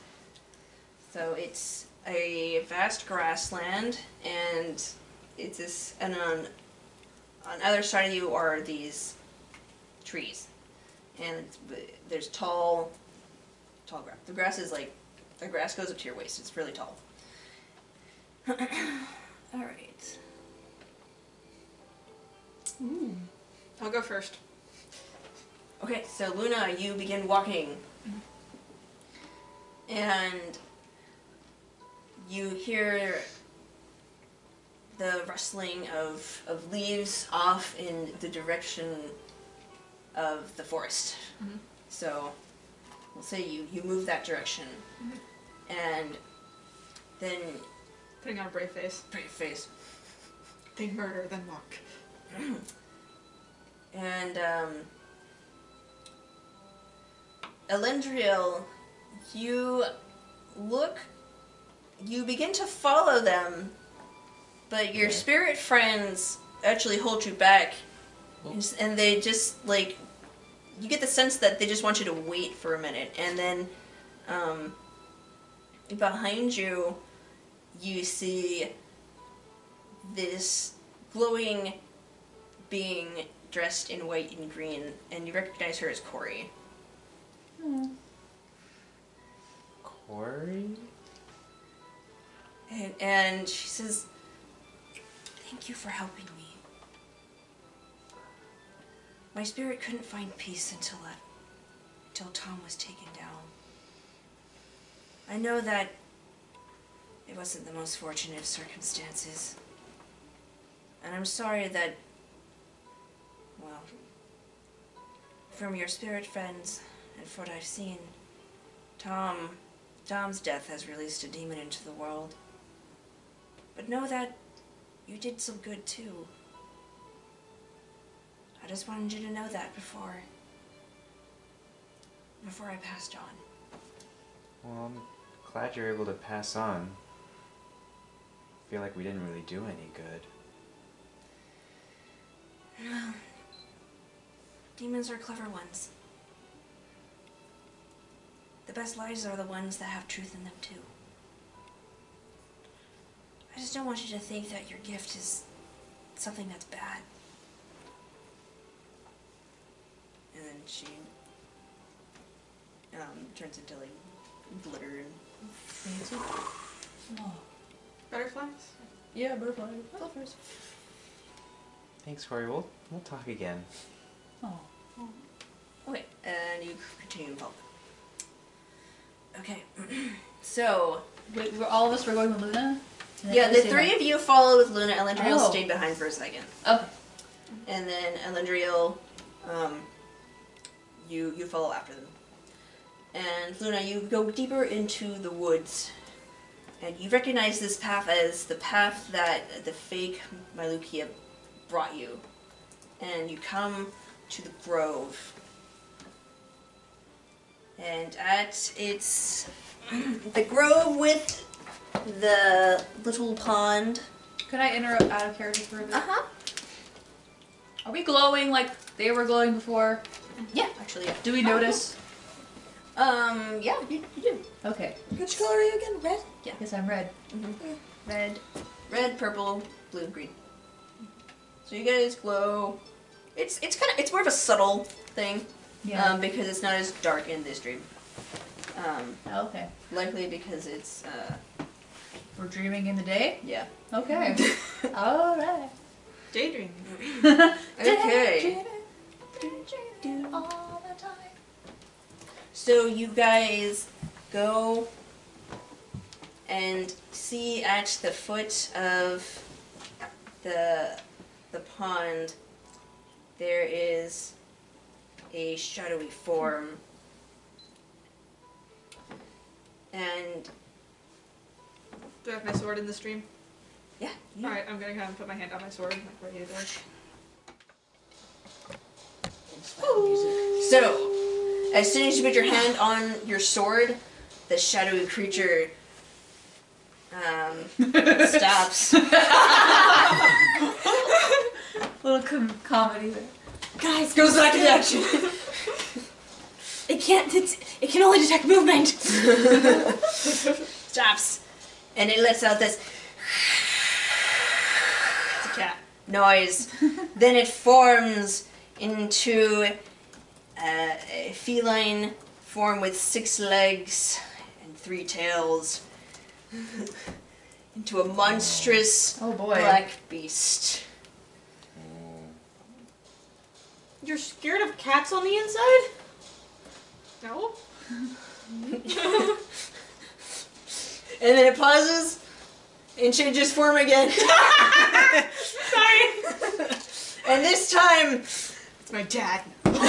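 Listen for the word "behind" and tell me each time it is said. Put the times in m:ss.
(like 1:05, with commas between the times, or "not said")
1:15, 3:05.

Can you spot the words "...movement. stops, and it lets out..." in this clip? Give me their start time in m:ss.
4:58.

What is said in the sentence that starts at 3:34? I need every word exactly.
Could I interrupt out of character for a bit?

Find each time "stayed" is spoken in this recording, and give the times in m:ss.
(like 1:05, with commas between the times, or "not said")
3:05.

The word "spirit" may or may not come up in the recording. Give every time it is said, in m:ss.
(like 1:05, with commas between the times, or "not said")
1:05, 1:39, 1:55.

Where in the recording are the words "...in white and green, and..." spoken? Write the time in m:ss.
1:23.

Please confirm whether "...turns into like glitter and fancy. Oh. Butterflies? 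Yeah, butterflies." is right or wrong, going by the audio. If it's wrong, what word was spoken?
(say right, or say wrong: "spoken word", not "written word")
right.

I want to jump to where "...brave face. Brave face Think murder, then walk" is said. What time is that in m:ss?
0:48.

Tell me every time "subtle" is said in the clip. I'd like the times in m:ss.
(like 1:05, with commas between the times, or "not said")
3:54.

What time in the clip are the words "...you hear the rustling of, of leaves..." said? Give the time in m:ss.
0:32.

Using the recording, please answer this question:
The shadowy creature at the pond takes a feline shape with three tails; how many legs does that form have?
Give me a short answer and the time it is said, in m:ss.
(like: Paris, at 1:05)
6, at 5:12.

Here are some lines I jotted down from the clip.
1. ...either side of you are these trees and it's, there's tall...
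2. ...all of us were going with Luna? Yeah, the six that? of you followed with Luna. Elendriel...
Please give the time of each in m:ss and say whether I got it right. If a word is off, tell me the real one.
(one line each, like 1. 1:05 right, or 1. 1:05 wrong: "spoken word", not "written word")
1. 0:07 right
2. 3:01 wrong: "three", not "six".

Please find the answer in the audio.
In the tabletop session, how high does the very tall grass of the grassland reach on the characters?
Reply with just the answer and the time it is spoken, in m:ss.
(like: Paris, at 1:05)
Up to your waist, at 0:15.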